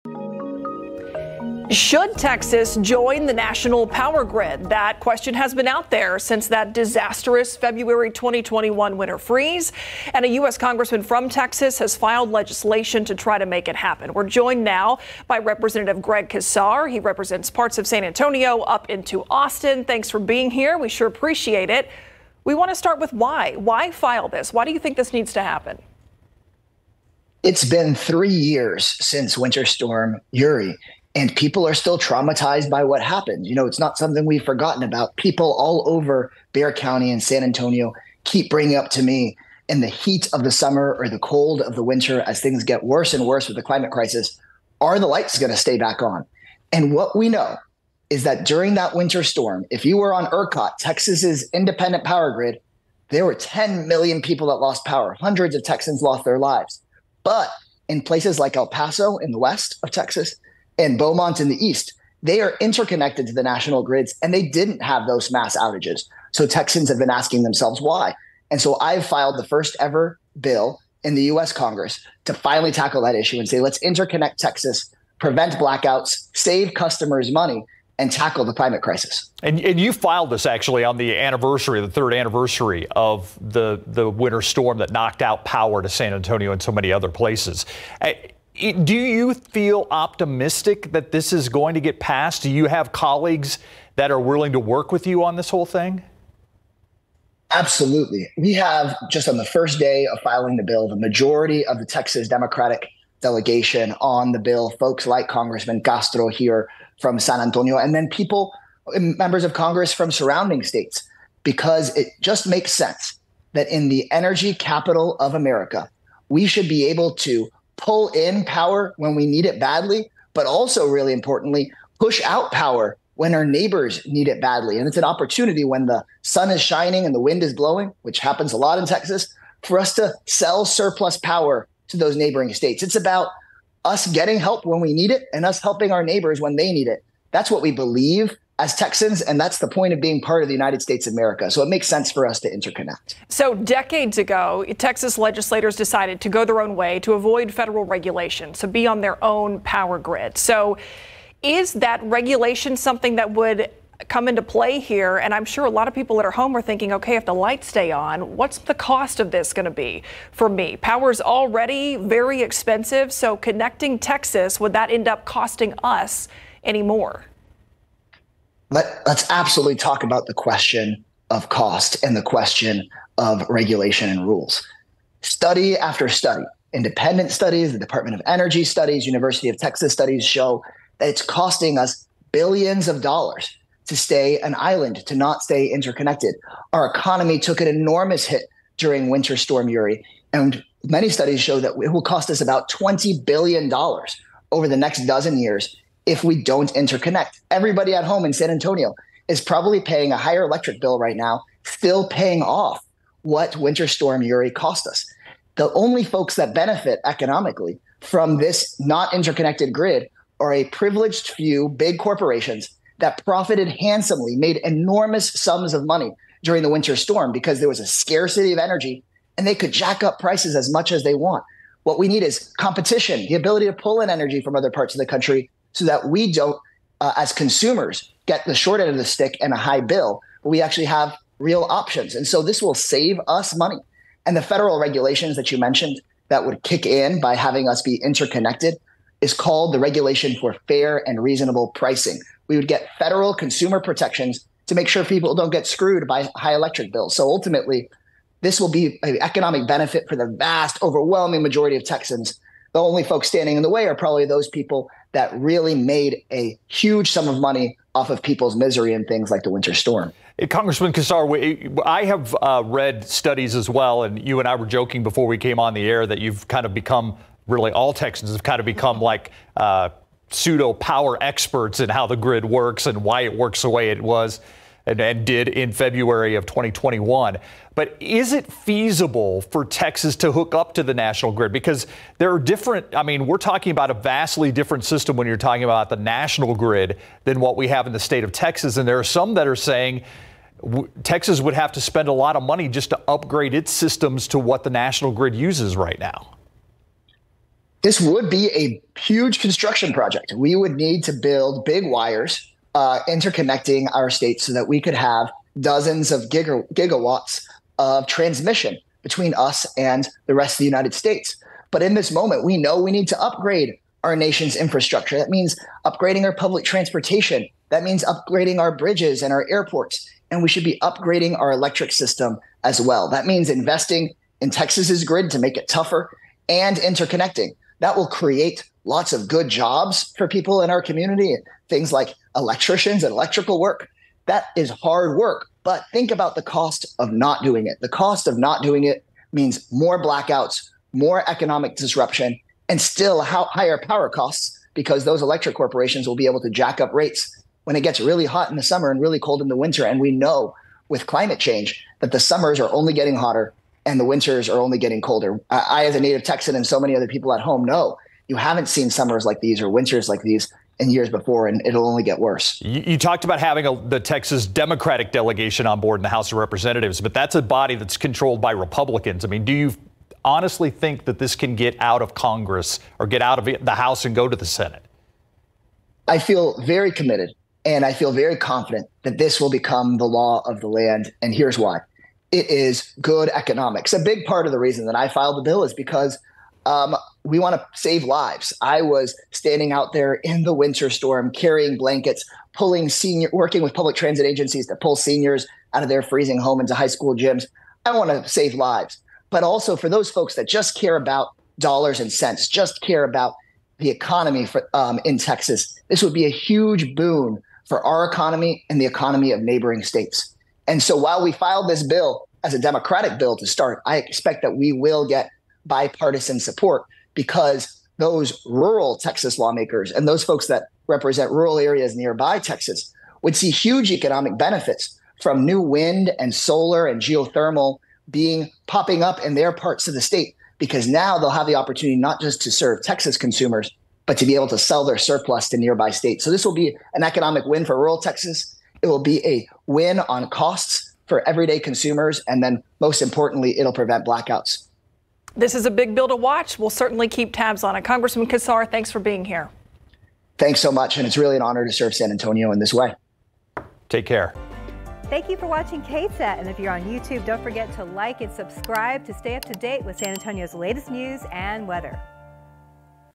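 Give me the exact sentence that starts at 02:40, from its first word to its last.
Power is already very expensive, so connecting Texas, would that end up costing us any more?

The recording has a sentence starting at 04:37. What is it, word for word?
But is it feasible for Texas to hook up to the national grid?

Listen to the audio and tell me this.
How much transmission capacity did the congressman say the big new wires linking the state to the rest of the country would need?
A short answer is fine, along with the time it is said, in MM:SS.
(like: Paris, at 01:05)
dozens of gigawatts, at 05:05.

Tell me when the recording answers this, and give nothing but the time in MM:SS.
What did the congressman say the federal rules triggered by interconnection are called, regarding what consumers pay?
04:00.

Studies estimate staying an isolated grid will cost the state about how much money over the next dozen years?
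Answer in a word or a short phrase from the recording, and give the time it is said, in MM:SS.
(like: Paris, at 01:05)
$20 billion, at 03:12.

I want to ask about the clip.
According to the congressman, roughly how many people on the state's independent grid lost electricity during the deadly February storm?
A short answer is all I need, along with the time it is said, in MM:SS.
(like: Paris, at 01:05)
10 million, at 00:53.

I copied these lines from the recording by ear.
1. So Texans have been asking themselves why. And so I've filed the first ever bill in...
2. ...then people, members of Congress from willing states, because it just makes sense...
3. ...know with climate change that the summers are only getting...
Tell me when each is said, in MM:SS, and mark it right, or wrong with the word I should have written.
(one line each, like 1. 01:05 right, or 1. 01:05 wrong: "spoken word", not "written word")
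1. 01:06 right
2. 01:47 wrong: "surrounding", not "willing"
3. 05:50 right.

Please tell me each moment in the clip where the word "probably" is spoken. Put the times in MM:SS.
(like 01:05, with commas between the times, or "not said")
03:19, 04:13.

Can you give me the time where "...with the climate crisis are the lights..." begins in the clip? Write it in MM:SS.
00:43.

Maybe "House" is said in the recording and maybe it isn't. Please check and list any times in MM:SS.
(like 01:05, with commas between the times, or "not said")
06:06, 06:13.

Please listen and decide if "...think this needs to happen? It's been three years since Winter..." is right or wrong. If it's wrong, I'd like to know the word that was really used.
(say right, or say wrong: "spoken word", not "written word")
right.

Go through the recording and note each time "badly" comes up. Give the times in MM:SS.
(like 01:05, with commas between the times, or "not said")
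01:59, 02:04.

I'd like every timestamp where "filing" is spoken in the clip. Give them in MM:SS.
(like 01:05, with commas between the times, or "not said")
01:40.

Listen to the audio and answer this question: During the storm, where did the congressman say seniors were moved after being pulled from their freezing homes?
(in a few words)
high school gyms.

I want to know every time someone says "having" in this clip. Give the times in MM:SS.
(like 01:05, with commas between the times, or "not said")
03:57, 06:03.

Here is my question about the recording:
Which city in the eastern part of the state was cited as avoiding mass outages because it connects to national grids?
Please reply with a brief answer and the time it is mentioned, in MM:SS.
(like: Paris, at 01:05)
Beaumont, at 01:00.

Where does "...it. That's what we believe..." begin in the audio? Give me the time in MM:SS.
02:16.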